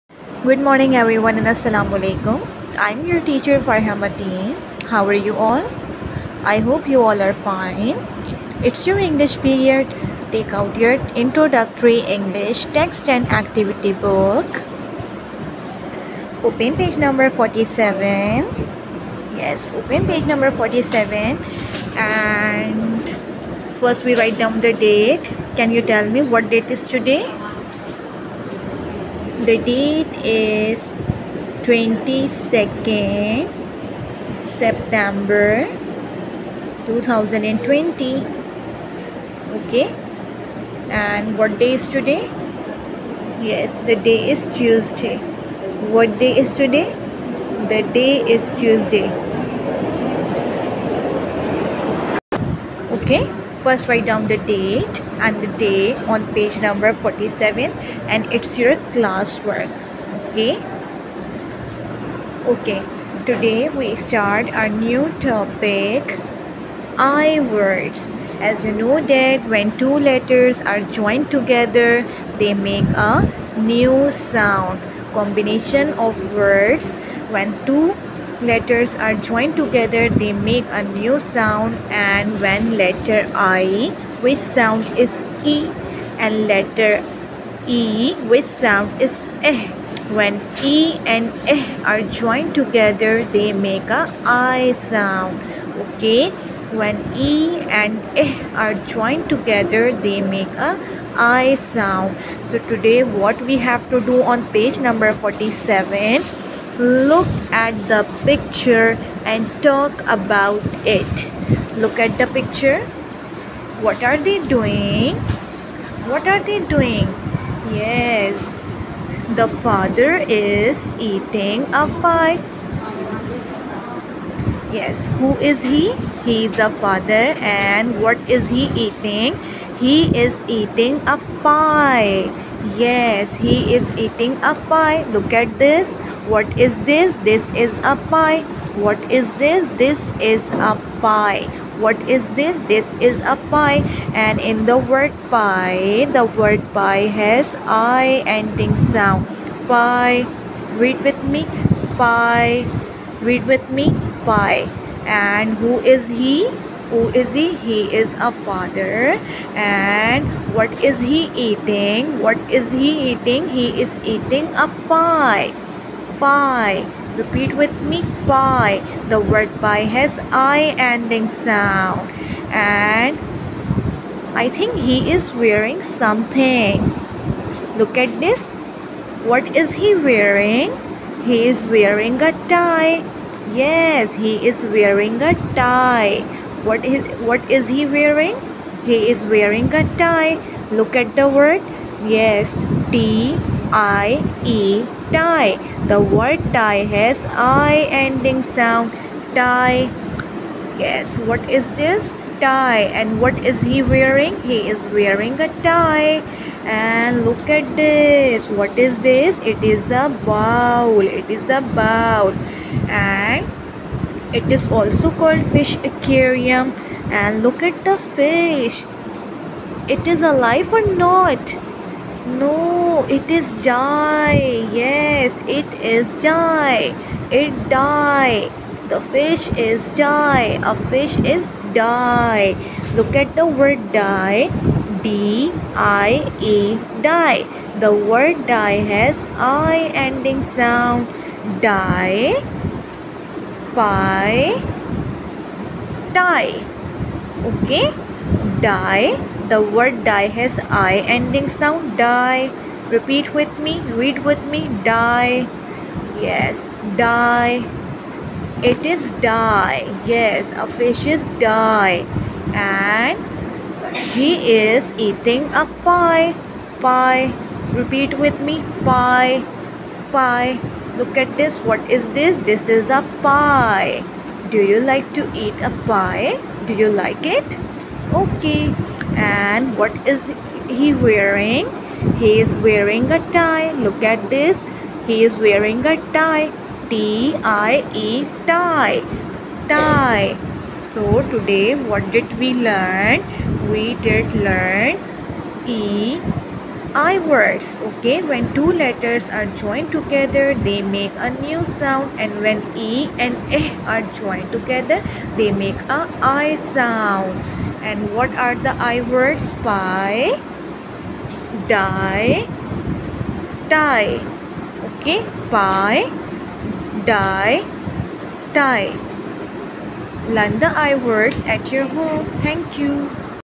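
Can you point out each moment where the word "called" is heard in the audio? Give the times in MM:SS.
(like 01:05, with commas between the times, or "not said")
03:35.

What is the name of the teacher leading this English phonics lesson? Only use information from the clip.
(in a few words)
Farhamati.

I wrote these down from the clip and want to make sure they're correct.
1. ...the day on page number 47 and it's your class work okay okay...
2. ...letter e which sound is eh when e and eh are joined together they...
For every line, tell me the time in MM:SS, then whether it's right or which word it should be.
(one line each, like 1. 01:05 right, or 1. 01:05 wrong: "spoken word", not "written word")
1. 00:55 right
2. 01:26 right.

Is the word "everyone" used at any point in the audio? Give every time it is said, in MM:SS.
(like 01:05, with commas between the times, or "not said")
00:00.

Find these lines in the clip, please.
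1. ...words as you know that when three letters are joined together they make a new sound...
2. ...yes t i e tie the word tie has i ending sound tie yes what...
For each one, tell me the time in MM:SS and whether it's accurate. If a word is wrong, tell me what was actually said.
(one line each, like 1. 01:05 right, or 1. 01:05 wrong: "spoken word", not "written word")
1. 01:07 wrong: "two", not "three"
2. 03:12 right.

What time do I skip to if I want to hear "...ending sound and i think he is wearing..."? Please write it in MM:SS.
02:50.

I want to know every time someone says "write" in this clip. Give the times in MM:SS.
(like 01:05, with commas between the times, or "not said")
00:24, 00:53.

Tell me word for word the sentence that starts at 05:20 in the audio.
Learn the I words at your home.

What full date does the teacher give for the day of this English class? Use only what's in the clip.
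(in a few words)
22nd September 2020.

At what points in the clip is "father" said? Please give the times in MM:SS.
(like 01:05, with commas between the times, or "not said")
01:59, 02:06, 02:38.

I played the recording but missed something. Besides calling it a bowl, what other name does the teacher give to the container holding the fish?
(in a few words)
fish aquarium.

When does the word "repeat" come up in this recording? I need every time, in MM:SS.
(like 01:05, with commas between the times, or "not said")
02:47, 04:12, 04:27.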